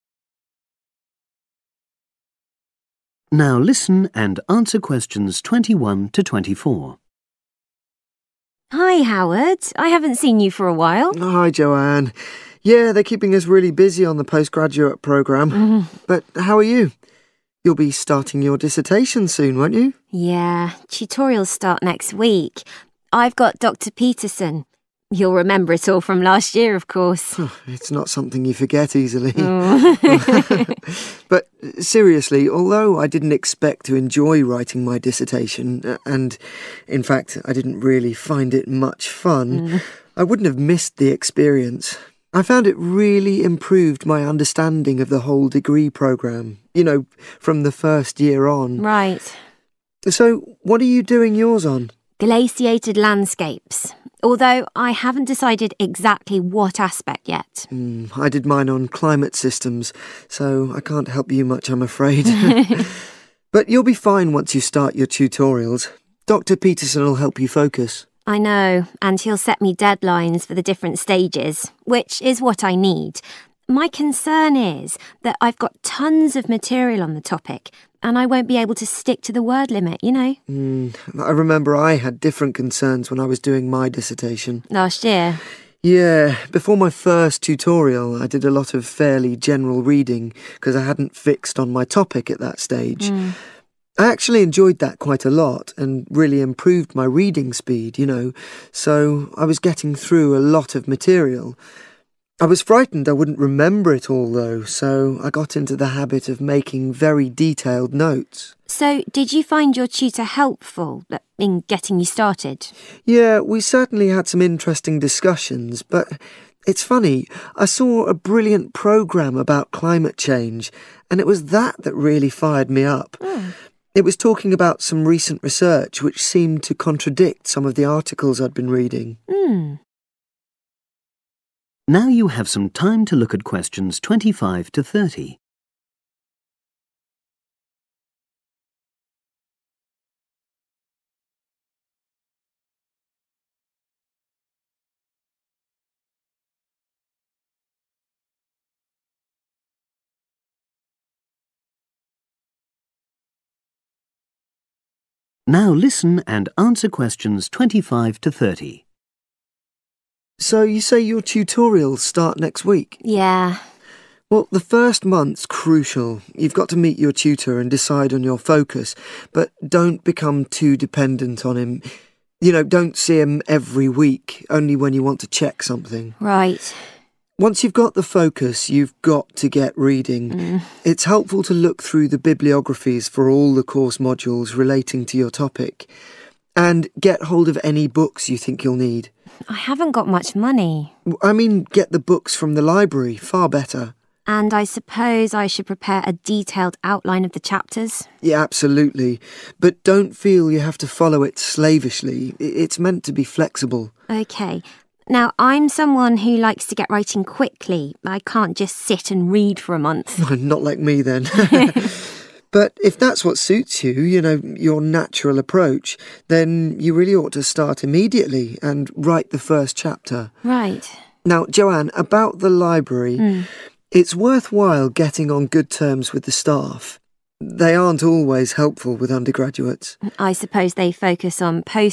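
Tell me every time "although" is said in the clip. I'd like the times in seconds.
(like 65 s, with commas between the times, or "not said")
32 s, 54 s.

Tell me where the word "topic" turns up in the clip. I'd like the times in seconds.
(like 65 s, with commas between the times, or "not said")
77 s, 91 s, 185 s.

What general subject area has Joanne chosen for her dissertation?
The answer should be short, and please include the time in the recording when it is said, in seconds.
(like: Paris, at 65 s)
Glaciated landscapes, at 52 s.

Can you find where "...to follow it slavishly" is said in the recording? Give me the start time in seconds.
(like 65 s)
200 s.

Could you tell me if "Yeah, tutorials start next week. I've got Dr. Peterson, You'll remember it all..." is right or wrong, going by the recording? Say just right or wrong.
right.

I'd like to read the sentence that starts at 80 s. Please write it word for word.
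Mm, I remember I had different concerns when I was doing my dissertation.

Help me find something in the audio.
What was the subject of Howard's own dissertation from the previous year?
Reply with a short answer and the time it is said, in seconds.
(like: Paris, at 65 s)
Climate systems, at 58 s.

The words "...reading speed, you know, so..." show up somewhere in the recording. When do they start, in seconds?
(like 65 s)
97 s.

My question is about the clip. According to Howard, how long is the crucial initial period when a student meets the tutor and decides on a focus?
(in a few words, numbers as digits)
The first month.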